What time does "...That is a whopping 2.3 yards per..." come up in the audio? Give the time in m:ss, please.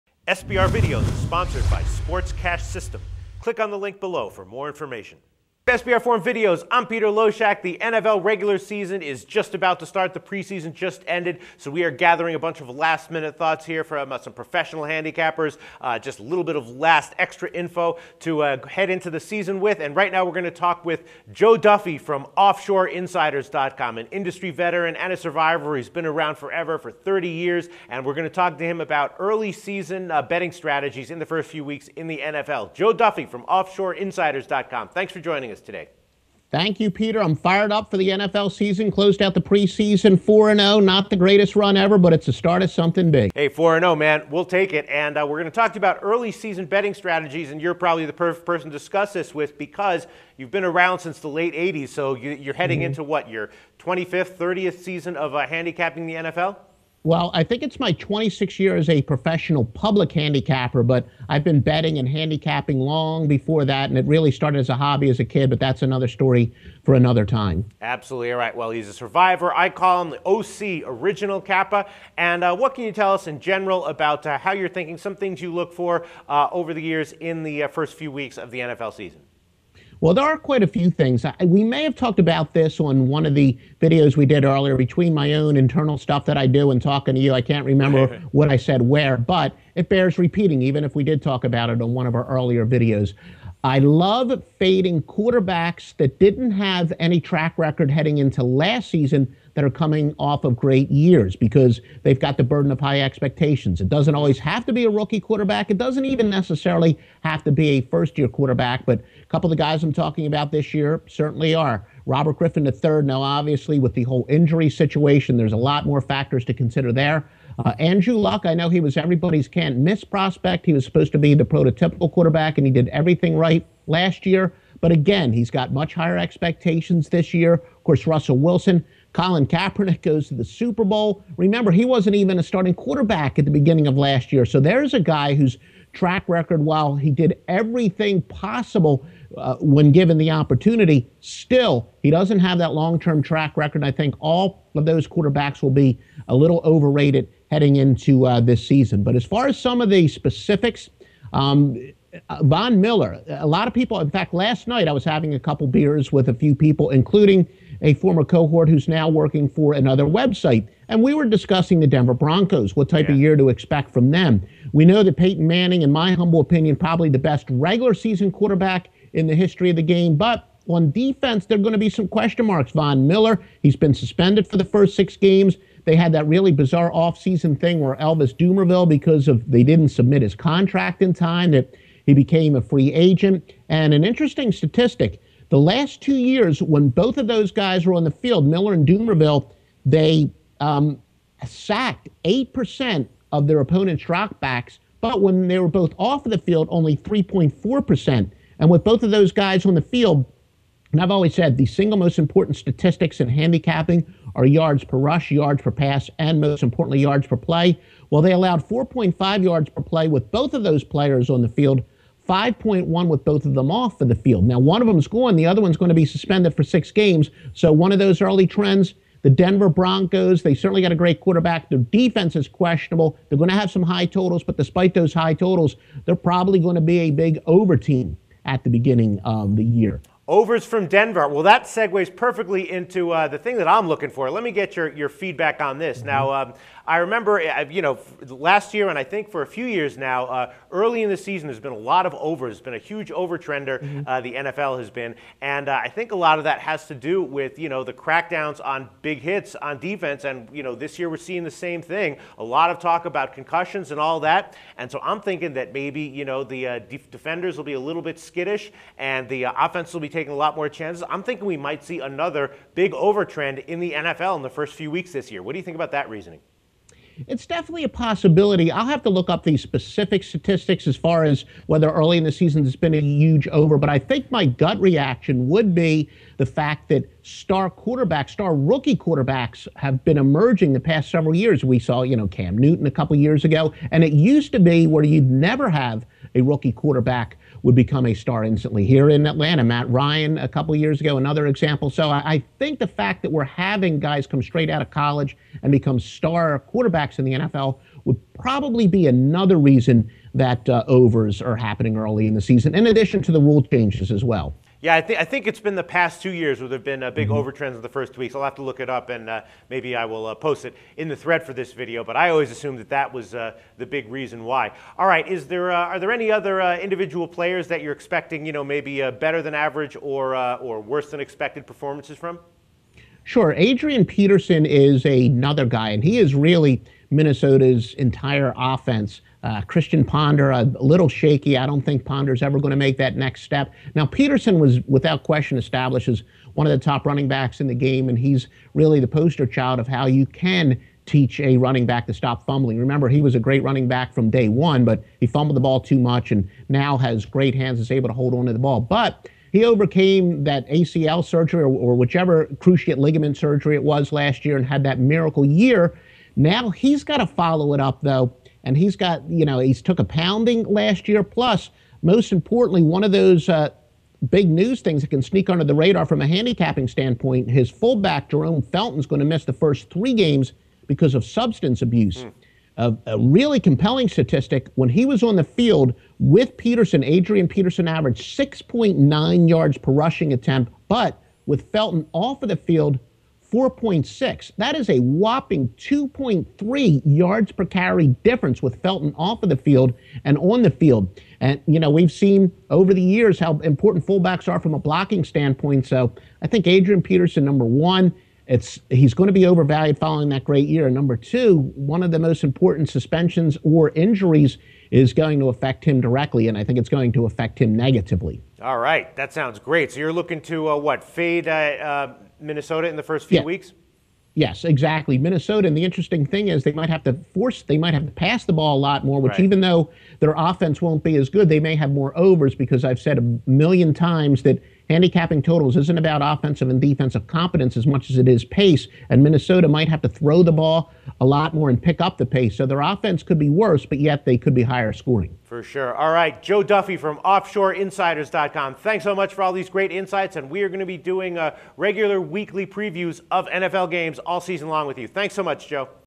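6:24.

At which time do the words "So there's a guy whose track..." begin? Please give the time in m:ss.
2:14.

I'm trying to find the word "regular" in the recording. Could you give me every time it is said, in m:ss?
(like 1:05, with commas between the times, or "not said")
0:08, 2:47, 7:21.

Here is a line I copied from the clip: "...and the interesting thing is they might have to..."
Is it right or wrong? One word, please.
right.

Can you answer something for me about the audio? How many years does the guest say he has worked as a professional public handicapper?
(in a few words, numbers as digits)
26.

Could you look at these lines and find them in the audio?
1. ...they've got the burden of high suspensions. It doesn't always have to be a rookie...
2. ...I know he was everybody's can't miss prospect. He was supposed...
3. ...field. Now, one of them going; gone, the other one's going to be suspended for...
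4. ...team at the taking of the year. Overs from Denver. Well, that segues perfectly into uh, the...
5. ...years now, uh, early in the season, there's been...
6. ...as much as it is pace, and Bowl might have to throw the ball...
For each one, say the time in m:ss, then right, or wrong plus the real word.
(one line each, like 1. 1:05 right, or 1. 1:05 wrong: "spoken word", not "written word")
1. 1:42 wrong: "expectations", not "suspensions"
2. 1:58 right
3. 3:34 right
4. 3:47 wrong: "beginning", not "taking"
5. 3:59 right
6. 7:07 wrong: "Minnesota", not "Bowl".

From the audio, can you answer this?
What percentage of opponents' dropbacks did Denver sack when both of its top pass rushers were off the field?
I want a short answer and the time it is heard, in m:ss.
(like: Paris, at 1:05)
3.4 percent, at 3:16.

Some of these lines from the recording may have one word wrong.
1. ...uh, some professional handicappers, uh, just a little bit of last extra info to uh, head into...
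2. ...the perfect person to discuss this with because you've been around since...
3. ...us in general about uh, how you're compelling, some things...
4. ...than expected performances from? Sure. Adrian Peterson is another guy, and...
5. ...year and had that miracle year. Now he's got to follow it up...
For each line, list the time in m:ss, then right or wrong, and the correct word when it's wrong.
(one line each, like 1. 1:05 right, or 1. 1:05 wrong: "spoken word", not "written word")
1. 0:14 right
2. 0:48 right
3. 1:13 wrong: "thinking", not "compelling"
4. 5:21 right
5. 5:54 right.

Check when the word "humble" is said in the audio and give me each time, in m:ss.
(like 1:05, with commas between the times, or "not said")
2:46.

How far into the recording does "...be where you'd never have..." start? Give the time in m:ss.
4:44.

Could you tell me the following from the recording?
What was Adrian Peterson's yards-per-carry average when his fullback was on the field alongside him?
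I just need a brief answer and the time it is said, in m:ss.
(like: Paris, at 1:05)
6.9, at 6:18.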